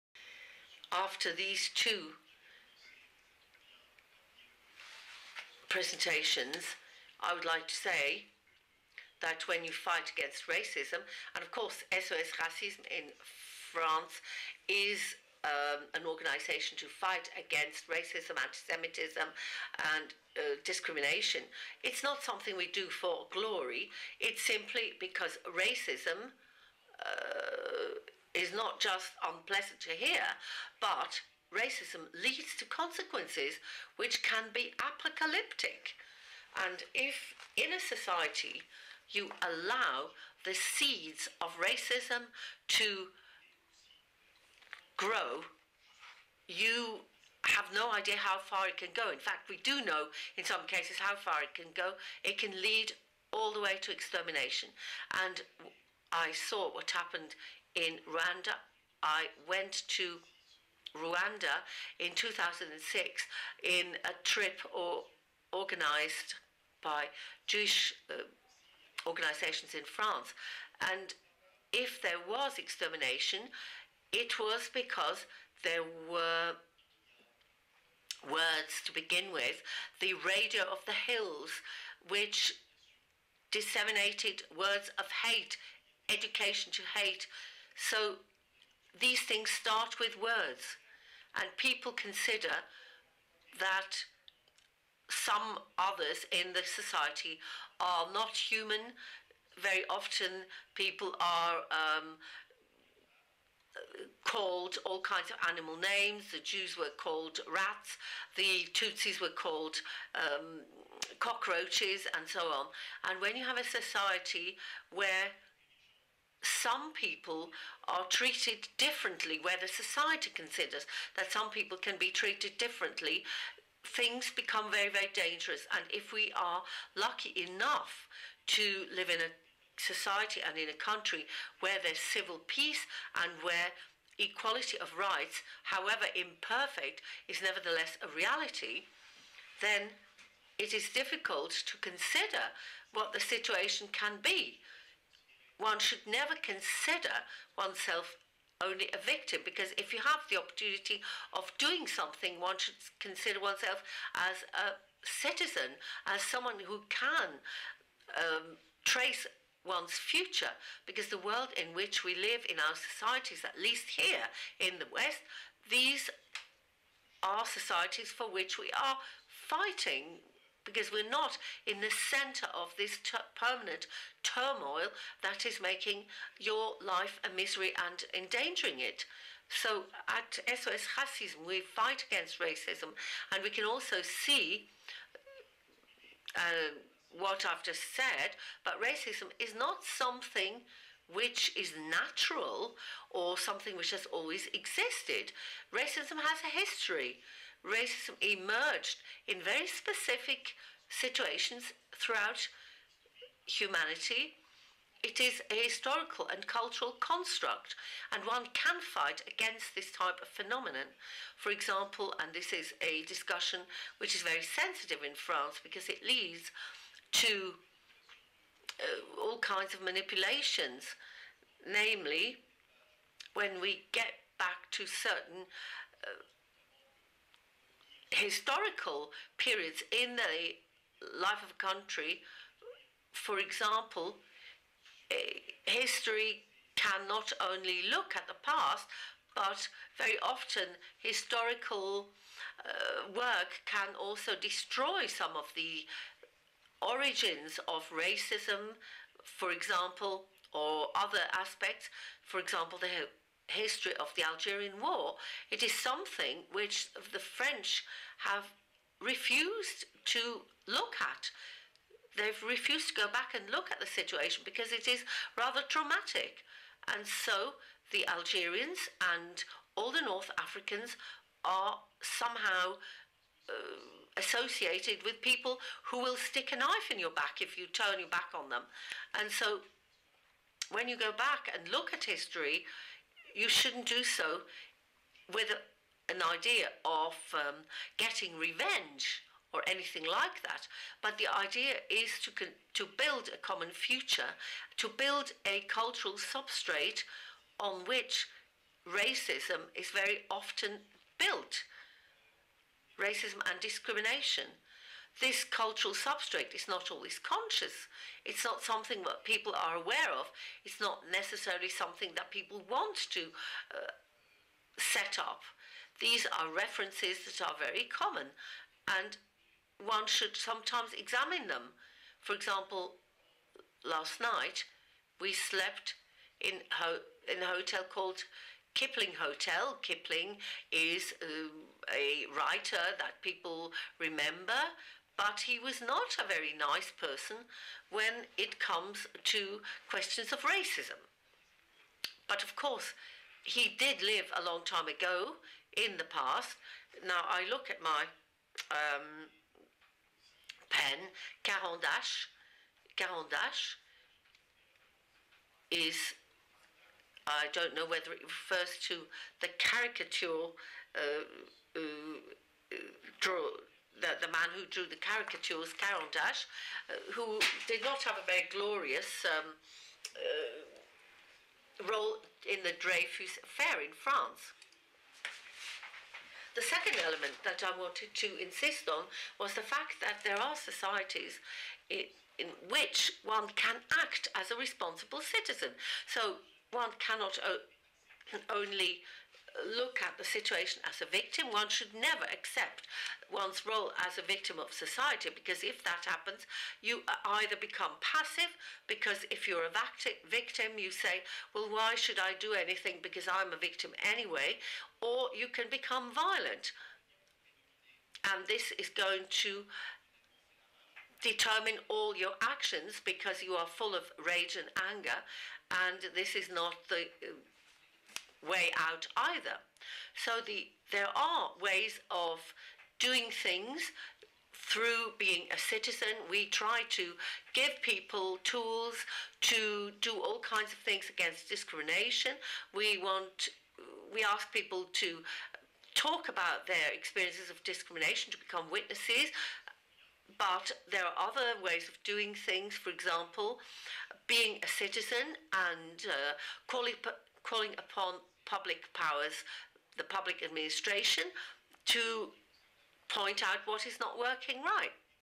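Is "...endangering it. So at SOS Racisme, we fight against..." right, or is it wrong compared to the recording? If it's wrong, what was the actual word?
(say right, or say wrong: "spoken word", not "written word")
right.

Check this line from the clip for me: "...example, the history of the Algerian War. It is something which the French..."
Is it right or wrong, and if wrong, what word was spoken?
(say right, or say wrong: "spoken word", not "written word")
right.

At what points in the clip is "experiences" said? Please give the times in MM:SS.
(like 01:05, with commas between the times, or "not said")
07:16.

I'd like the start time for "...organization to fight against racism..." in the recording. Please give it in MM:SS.
00:16.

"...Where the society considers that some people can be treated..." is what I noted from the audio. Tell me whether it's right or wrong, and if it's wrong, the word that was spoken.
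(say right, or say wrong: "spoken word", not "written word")
right.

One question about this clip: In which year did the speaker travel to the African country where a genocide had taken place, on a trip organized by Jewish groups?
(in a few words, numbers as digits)
2006.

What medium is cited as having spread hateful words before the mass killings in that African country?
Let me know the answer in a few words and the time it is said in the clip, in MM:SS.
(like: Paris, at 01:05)
the radio of the hills, at 01:19.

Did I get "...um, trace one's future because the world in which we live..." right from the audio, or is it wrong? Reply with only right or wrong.
right.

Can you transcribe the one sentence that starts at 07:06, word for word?
We try to give people tools to do all kinds of things against discrimination.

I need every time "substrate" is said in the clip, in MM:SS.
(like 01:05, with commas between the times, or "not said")
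04:56, 05:05.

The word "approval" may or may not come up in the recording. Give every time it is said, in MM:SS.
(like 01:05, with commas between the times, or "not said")
not said.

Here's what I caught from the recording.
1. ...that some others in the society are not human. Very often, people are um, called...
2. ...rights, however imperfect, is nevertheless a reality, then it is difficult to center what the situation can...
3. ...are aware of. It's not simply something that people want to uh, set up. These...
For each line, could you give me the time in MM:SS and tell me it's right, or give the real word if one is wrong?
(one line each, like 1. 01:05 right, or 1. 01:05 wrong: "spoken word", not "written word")
1. 01:33 right
2. 02:14 wrong: "consider", not "center"
3. 05:09 wrong: "necessarily", not "simply".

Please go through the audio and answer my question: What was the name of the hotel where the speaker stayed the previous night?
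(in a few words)
Kipling Hotel.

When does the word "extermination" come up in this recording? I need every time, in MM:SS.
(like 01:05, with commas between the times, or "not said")
00:53, 01:12.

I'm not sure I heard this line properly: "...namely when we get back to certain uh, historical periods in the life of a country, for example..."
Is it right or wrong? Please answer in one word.
right.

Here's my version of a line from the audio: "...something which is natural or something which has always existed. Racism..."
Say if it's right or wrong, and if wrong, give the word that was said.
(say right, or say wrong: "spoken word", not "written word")
right.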